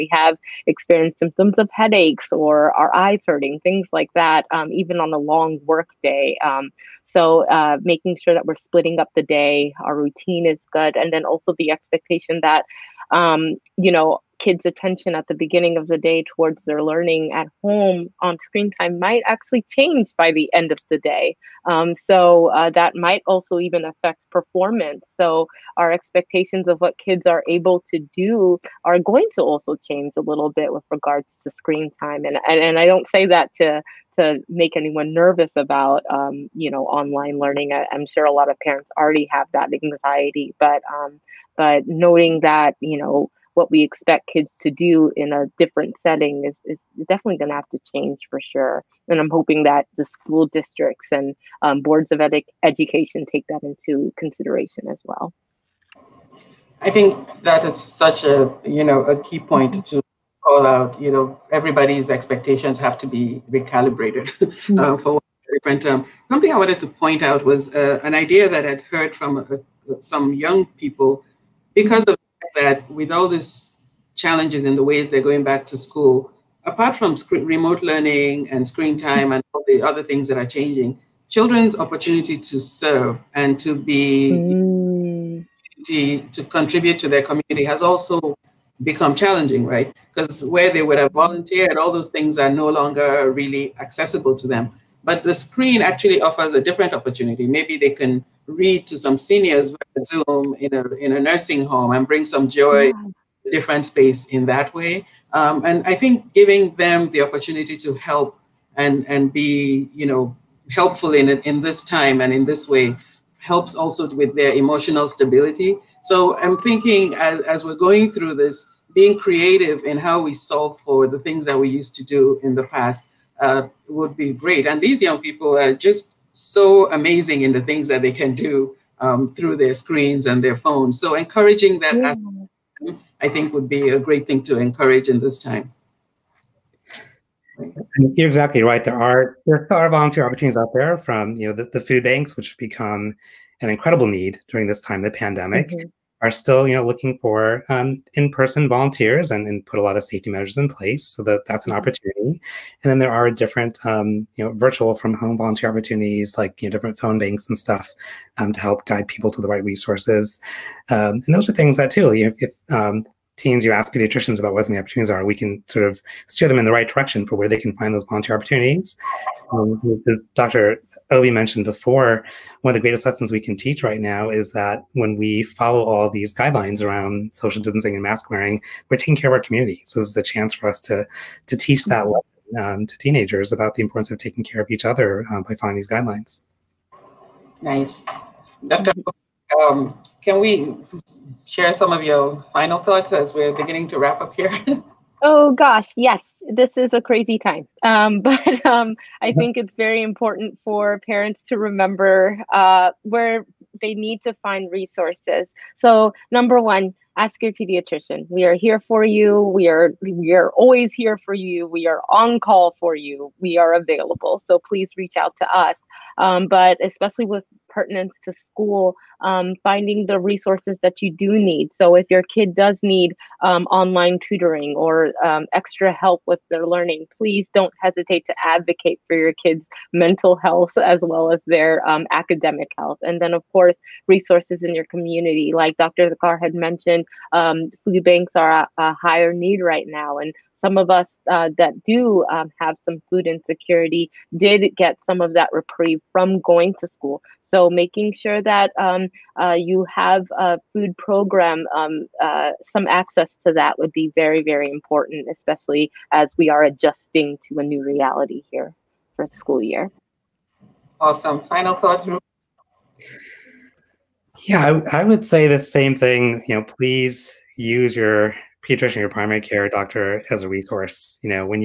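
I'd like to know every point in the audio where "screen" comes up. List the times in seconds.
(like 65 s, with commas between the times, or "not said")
18 s, 31 s, 78 s, 95 s, 129 s.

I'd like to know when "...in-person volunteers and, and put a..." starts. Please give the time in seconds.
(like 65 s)
148 s.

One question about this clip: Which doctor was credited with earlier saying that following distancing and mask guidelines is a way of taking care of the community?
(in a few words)
Dr. Obih.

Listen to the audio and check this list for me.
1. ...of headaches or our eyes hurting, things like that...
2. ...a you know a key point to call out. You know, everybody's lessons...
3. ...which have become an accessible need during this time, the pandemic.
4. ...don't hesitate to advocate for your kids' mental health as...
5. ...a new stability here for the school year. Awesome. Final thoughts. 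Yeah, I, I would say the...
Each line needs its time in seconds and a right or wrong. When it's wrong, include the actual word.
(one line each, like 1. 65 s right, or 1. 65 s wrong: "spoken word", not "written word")
1. 1 s right
2. 58 s wrong: "expectations", not "lessons"
3. 142 s wrong: "incredible", not "accessible"
4. 227 s right
5. 257 s wrong: "reality", not "stability".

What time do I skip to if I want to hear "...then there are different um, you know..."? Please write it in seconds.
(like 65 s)
152 s.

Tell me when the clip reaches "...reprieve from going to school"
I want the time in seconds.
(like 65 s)
245 s.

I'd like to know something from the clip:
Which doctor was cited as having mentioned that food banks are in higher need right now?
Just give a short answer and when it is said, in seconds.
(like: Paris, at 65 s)
Dr. Thakkar, at 235 s.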